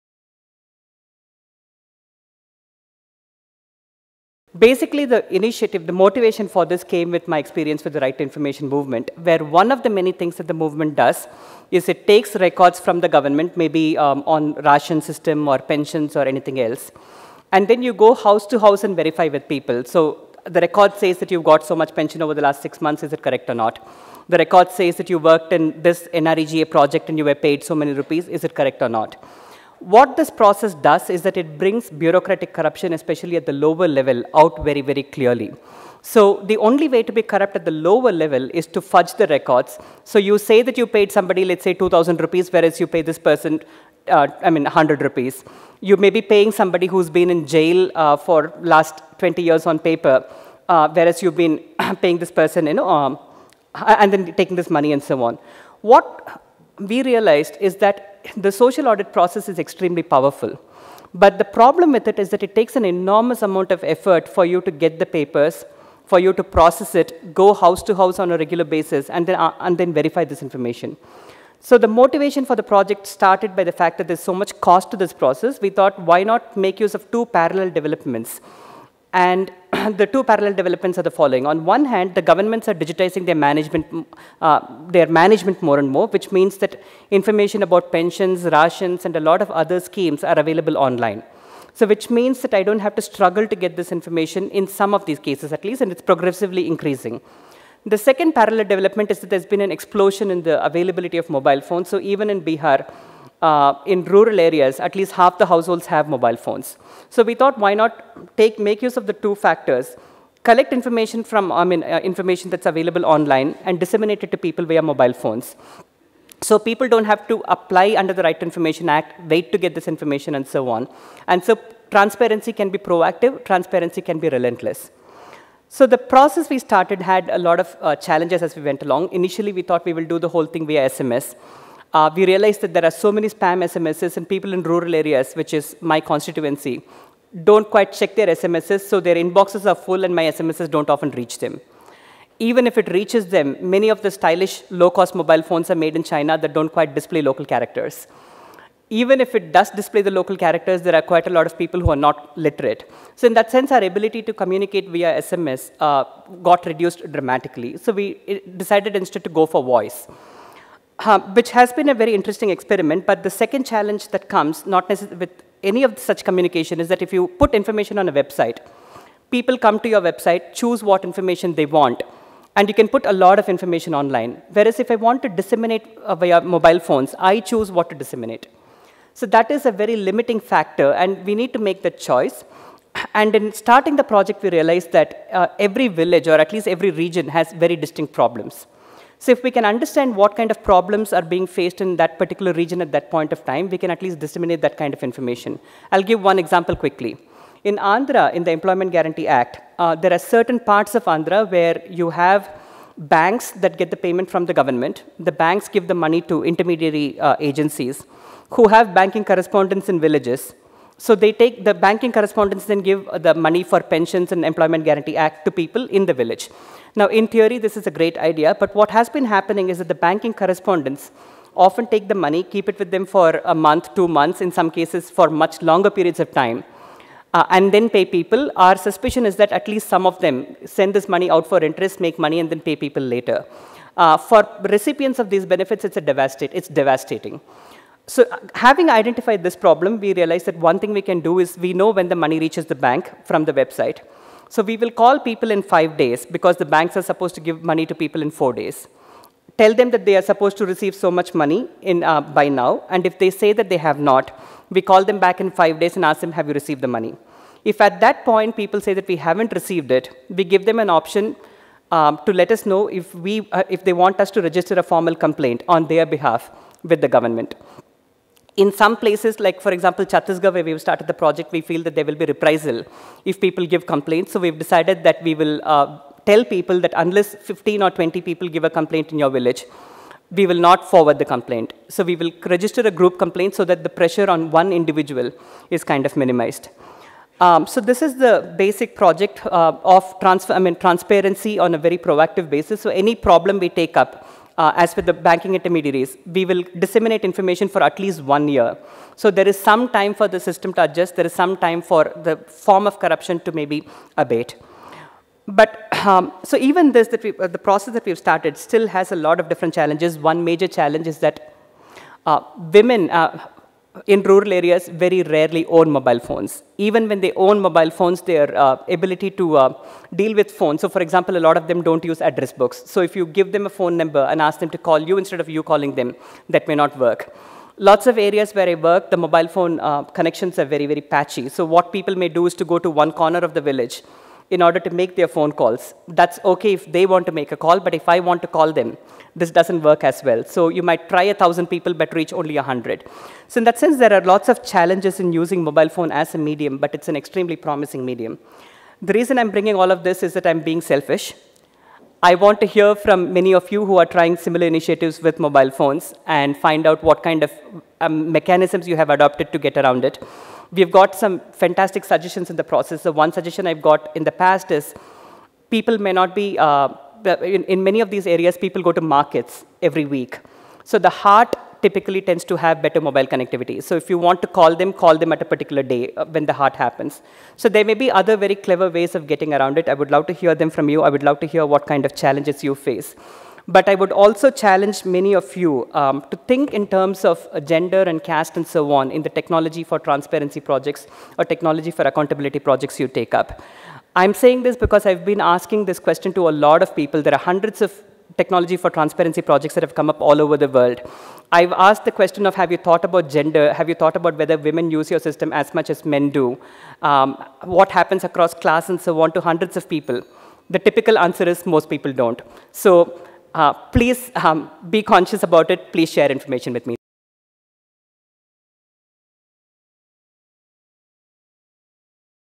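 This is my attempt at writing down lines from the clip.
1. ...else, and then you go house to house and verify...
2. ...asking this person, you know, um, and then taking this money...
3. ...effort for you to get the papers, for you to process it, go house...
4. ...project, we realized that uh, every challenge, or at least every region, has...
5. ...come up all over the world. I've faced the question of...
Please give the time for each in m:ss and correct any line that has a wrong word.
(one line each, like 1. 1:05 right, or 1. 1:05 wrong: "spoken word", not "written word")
1. 0:16 right
2. 0:52 wrong: "paying", not "asking"
3. 1:03 right
4. 3:04 wrong: "village", not "challenge"
5. 6:39 wrong: "asked", not "faced".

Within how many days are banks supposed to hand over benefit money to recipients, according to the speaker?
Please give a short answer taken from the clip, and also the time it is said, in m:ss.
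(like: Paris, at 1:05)
4, at 4:08.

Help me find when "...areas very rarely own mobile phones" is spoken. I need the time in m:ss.
5:14.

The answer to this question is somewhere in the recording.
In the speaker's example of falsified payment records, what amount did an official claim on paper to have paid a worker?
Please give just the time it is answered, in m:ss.
0:41.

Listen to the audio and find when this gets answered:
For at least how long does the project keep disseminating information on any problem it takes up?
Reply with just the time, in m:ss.
4:58.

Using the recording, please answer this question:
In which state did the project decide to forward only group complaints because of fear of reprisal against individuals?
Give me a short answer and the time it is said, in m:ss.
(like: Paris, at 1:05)
Chhattisgarh, at 4:30.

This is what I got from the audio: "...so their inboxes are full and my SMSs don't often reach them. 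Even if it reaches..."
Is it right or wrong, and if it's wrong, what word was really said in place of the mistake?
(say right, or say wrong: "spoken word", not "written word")
right.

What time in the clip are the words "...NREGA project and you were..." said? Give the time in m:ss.
0:26.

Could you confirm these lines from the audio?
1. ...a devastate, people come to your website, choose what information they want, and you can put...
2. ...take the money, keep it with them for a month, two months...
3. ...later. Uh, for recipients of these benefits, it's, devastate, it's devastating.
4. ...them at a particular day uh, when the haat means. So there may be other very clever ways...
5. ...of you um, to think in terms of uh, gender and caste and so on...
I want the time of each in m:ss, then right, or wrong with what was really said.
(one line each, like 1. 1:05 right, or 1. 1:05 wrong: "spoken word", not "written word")
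1. 2:48 wrong: "website", not "devastate"
2. 3:41 right
3. 3:53 right
4. 6:15 wrong: "happens", not "means"
5. 6:25 right.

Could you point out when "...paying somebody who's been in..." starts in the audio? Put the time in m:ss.
0:46.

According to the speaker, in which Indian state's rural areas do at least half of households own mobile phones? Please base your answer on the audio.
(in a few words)
Bihar.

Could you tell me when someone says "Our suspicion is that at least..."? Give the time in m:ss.
3:48.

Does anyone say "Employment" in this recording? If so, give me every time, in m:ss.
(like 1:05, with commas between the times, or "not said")
3:18, 3:34.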